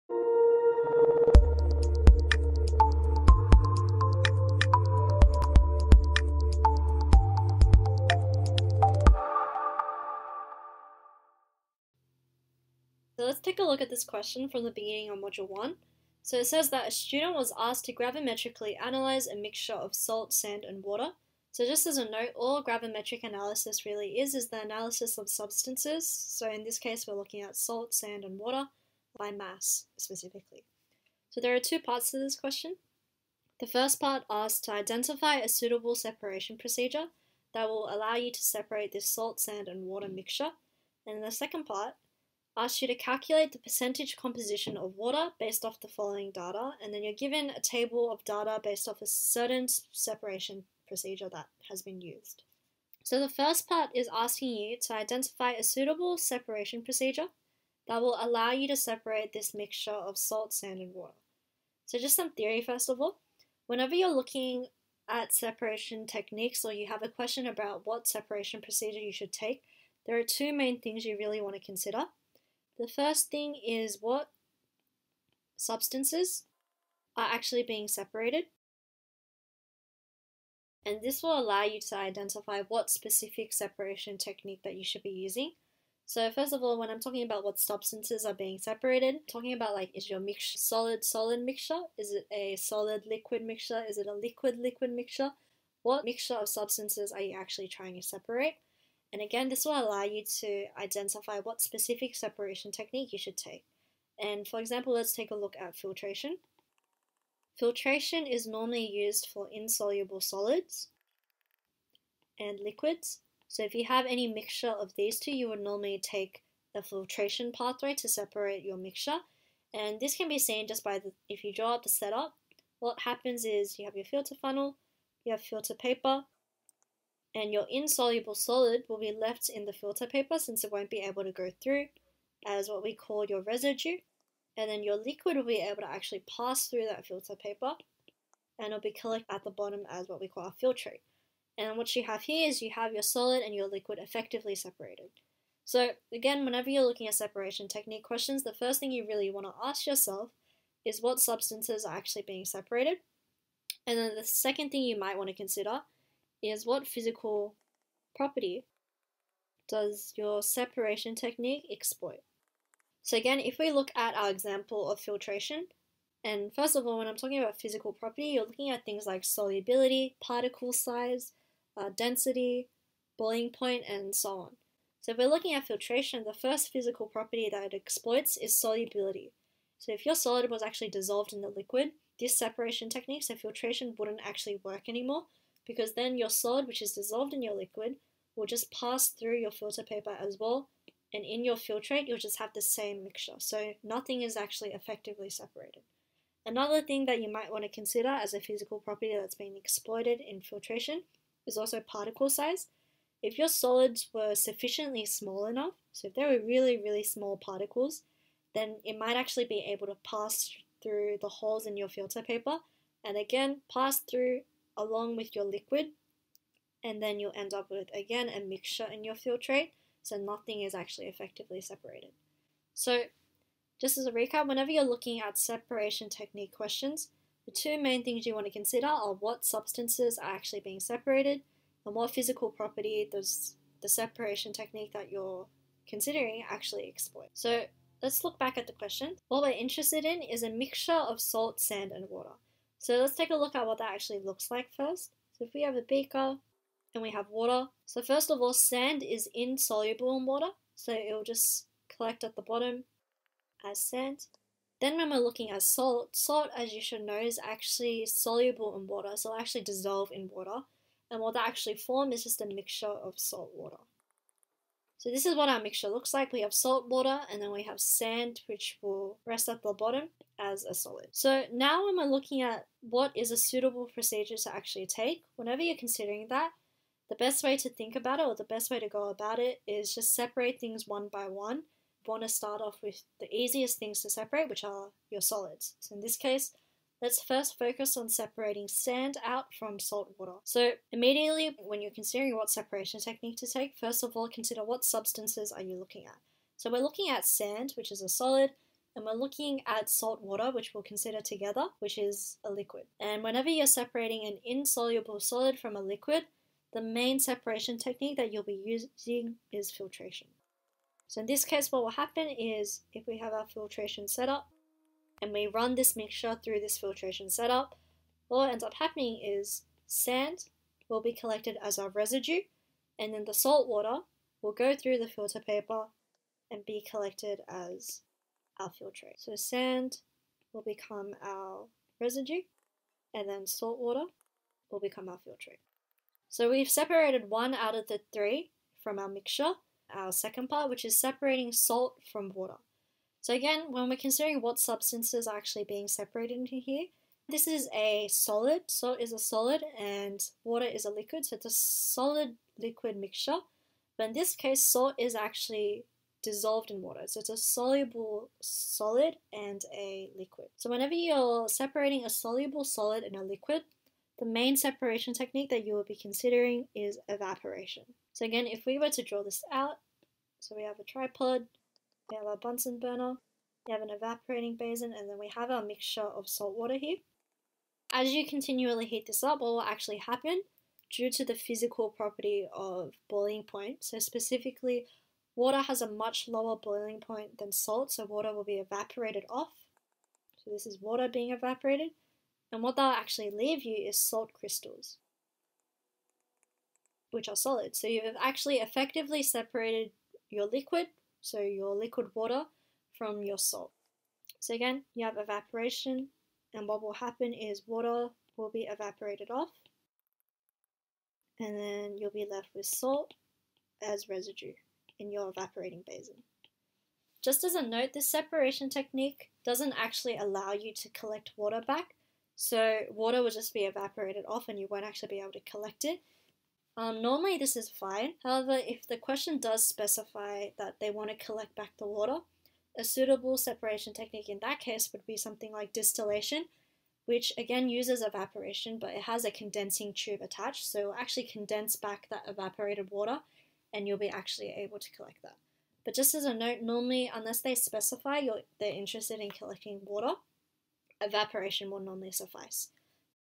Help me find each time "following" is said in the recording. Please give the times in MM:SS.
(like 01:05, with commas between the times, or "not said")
00:45.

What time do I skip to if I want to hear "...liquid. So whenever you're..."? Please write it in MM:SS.
06:00.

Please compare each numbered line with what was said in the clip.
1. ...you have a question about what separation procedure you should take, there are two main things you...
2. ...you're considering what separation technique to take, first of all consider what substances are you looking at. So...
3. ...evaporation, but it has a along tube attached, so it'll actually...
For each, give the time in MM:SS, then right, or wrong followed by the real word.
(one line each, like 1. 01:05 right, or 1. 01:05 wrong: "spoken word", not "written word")
1. 01:06 right
2. 04:51 right
3. 07:18 wrong: "condensing", not "along".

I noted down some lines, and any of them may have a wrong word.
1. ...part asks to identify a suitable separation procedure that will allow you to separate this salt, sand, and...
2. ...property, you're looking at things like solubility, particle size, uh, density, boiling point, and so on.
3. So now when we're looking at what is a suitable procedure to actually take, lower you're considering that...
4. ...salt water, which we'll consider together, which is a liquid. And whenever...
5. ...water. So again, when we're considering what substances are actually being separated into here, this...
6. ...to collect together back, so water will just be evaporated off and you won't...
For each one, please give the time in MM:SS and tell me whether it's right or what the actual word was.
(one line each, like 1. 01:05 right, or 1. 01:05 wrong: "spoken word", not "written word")
1. 00:33 right
2. 02:47 right
3. 04:31 wrong: "whenever", not "lower"
4. 04:59 right
5. 05:42 right
6. 07:00 wrong: "water", not "together".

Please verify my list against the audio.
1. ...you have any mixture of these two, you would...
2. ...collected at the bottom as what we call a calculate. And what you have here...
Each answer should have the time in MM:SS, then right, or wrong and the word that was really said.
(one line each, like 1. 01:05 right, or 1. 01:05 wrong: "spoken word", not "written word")
1. 01:53 right
2. 02:18 wrong: "filtrate", not "calculate".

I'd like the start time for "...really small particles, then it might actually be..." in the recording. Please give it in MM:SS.
03:26.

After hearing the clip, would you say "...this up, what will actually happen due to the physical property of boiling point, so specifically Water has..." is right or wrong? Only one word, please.
right.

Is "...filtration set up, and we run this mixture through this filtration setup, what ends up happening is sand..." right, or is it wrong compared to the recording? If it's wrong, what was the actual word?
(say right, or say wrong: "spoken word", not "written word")
right.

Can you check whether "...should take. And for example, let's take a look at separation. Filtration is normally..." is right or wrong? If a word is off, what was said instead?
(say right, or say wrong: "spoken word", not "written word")
wrong: "filtration", not "separation".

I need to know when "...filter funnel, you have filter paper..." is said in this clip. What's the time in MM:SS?
02:04.